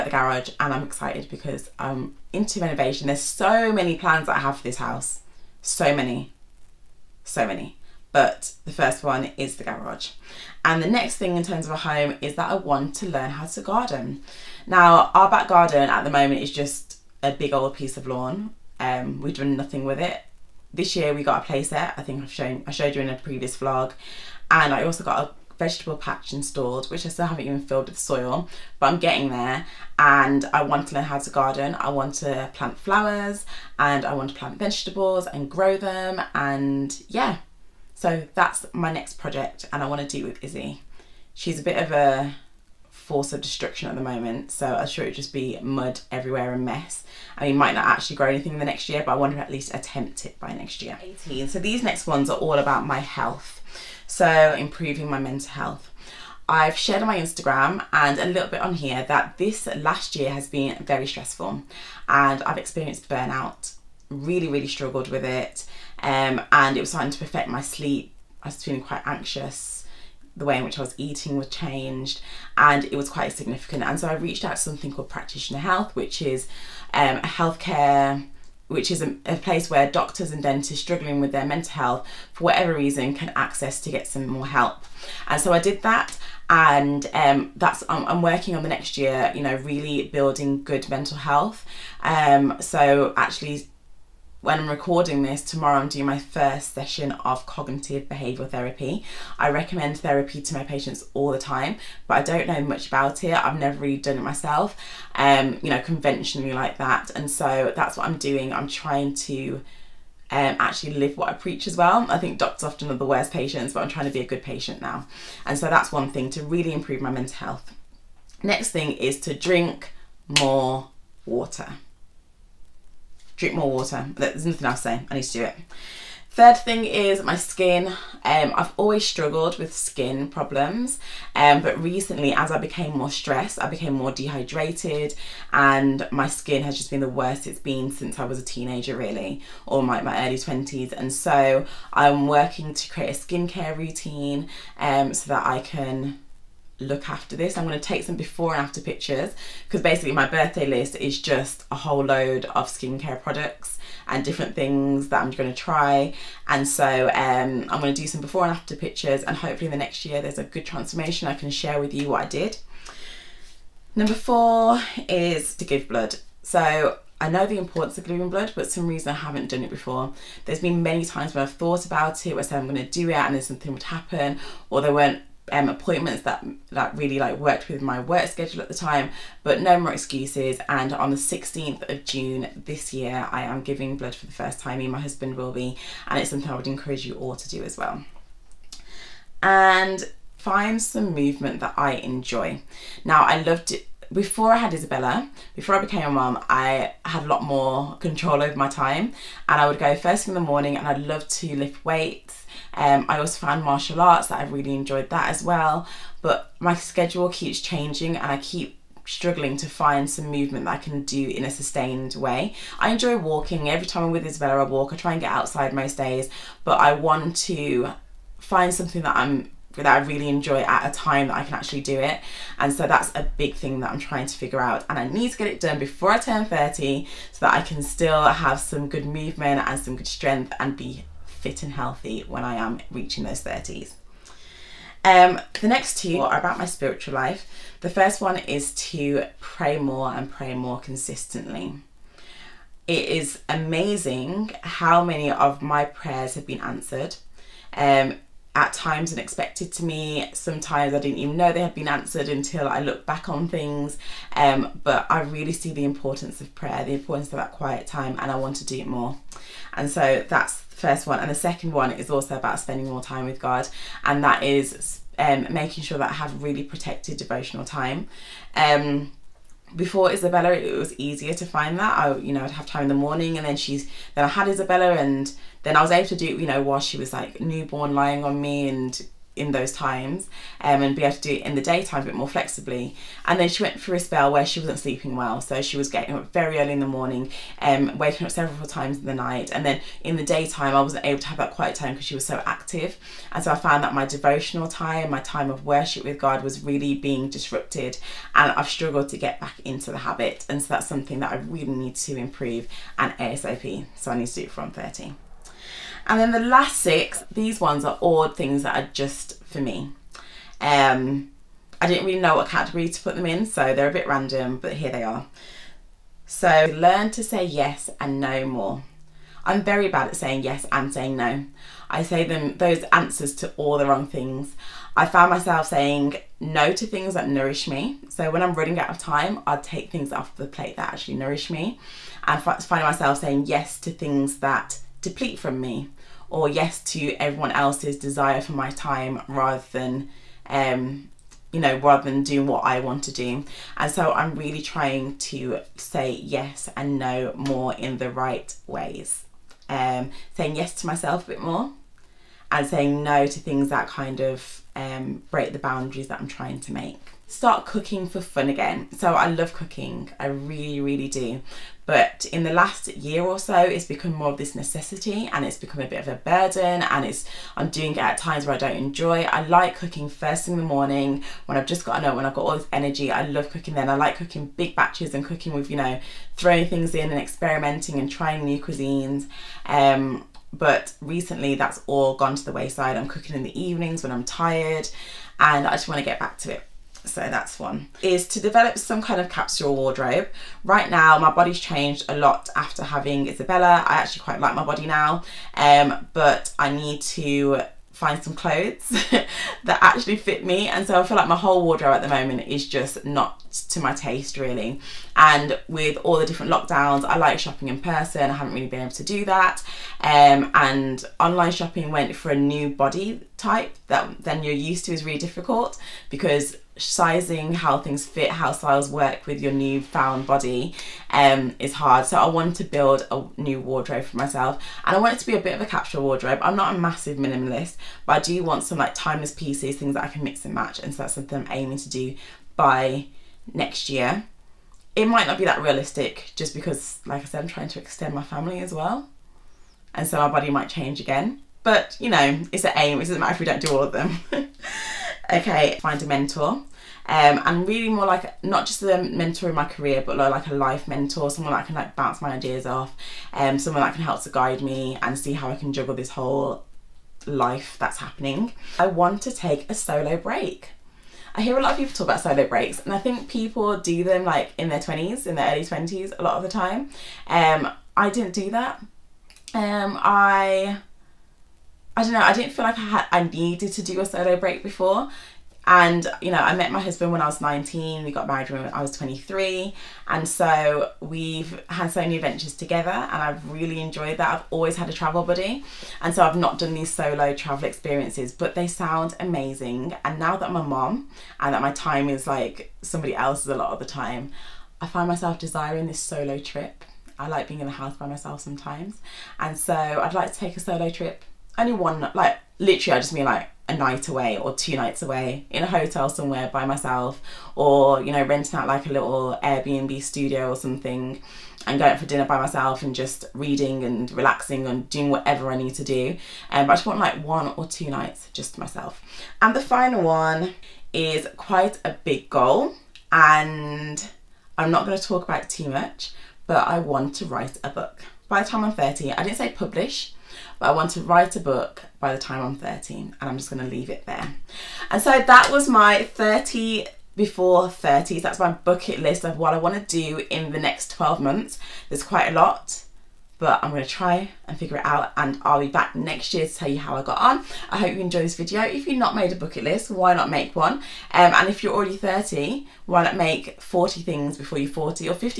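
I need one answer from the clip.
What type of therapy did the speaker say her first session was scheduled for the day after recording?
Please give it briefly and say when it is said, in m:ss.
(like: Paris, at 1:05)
Cognitive behavioural therapy, at 1:37.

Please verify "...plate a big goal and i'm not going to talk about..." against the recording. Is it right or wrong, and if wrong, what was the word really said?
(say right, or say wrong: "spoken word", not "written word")
wrong: "quite", not "plate".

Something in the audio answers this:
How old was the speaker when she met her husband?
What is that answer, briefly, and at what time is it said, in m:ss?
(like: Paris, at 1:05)
19, at 7:57.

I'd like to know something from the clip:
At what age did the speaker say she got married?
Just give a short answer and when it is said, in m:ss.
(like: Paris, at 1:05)
23, at 7:58.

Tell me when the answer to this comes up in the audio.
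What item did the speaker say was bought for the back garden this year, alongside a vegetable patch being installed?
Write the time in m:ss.
0:21.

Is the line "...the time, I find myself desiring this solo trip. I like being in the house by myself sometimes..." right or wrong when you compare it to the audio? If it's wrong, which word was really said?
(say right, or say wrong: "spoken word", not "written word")
right.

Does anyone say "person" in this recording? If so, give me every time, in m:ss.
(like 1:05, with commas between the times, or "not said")
6:47.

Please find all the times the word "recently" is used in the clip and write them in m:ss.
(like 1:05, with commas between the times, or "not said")
2:11, 6:20.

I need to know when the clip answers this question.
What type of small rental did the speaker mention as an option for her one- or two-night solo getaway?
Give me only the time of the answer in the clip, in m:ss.
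8:29.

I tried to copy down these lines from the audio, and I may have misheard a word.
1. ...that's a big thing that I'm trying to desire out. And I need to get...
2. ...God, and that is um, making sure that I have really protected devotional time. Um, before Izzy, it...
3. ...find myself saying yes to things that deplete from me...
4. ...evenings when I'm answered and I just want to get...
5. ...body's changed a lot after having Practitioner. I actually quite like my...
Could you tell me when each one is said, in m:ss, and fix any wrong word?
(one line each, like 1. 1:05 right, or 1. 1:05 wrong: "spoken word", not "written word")
1. 3:42 wrong: "figure", not "desire"
2. 4:23 wrong: "Isabella", not "Izzy"
3. 5:32 right
4. 6:23 wrong: "tired", not "answered"
5. 6:31 wrong: "Isabella", not "Practitioner".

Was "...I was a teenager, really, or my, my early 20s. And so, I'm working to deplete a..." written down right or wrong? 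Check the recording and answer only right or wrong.
wrong.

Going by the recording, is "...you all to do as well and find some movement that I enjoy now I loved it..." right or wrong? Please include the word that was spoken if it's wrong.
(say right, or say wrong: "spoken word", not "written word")
right.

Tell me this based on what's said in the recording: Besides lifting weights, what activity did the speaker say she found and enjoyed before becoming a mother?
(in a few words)
Martial arts.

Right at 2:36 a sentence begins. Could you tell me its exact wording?
And so um, I'm going to do some before and after pictures and hopefully in the next year there's a good transformation.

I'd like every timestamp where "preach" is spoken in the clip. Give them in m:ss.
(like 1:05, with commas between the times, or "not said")
1:51.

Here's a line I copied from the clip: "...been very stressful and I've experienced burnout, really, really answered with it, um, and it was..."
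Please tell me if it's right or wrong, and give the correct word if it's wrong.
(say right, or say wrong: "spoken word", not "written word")
wrong: "struggled", not "answered".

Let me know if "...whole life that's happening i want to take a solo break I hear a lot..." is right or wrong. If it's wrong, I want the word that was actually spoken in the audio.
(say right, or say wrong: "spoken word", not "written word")
right.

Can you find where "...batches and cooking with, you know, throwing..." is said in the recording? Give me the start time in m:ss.
6:14.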